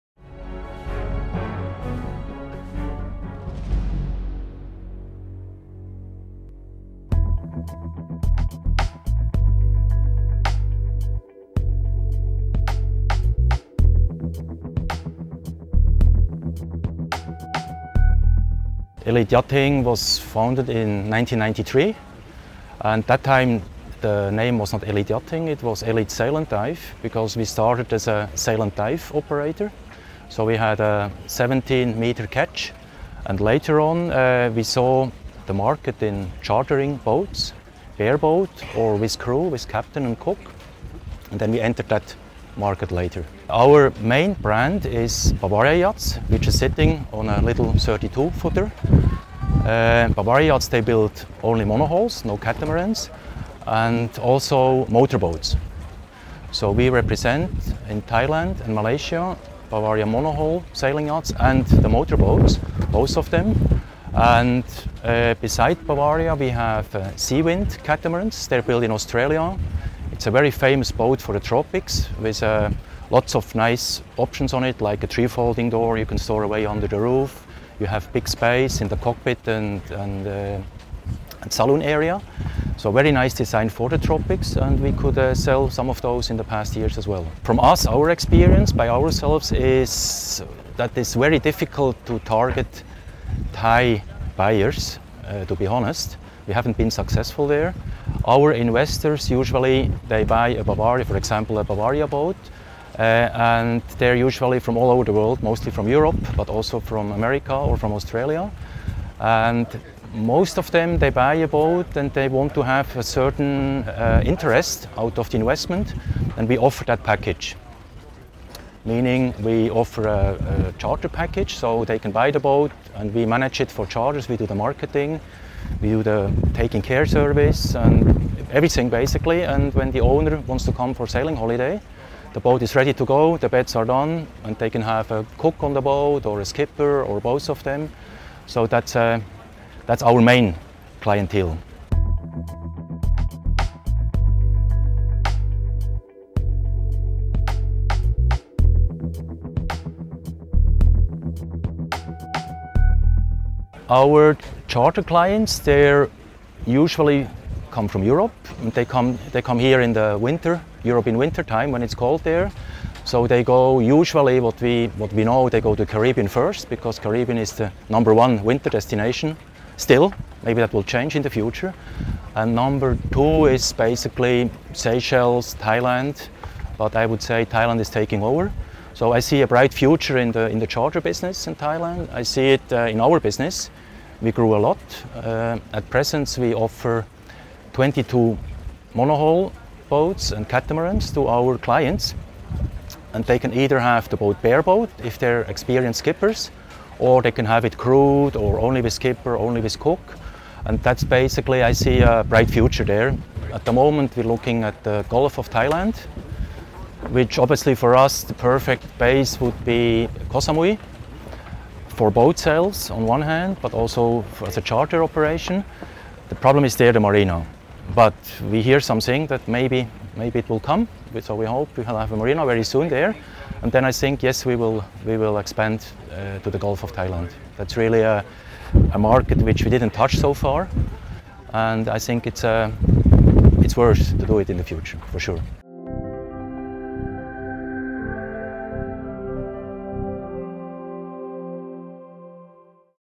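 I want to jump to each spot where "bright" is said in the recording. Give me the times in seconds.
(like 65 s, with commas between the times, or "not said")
179 s, 202 s.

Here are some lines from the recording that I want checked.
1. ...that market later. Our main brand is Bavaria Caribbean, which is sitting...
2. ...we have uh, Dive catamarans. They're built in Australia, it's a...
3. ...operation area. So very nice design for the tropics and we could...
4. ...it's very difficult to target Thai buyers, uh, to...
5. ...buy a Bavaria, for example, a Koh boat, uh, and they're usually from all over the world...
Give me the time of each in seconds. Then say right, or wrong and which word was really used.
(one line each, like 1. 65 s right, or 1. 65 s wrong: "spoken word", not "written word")
1. 41 s wrong: "Yachts", not "Caribbean"
2. 66 s wrong: "Seawind", not "Dive"
3. 81 s wrong: "saloon", not "operation"
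4. 90 s right
5. 100 s wrong: "Bavaria", not "Koh".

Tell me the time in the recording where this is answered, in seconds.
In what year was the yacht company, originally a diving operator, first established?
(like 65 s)
21 s.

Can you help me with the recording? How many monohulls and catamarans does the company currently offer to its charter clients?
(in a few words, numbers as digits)
22.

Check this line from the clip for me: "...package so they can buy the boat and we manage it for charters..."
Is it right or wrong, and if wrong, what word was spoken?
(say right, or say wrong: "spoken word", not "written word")
right.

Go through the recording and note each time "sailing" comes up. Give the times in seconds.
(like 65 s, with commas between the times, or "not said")
60 s, 131 s.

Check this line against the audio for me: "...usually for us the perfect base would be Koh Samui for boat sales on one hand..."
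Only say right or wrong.
wrong.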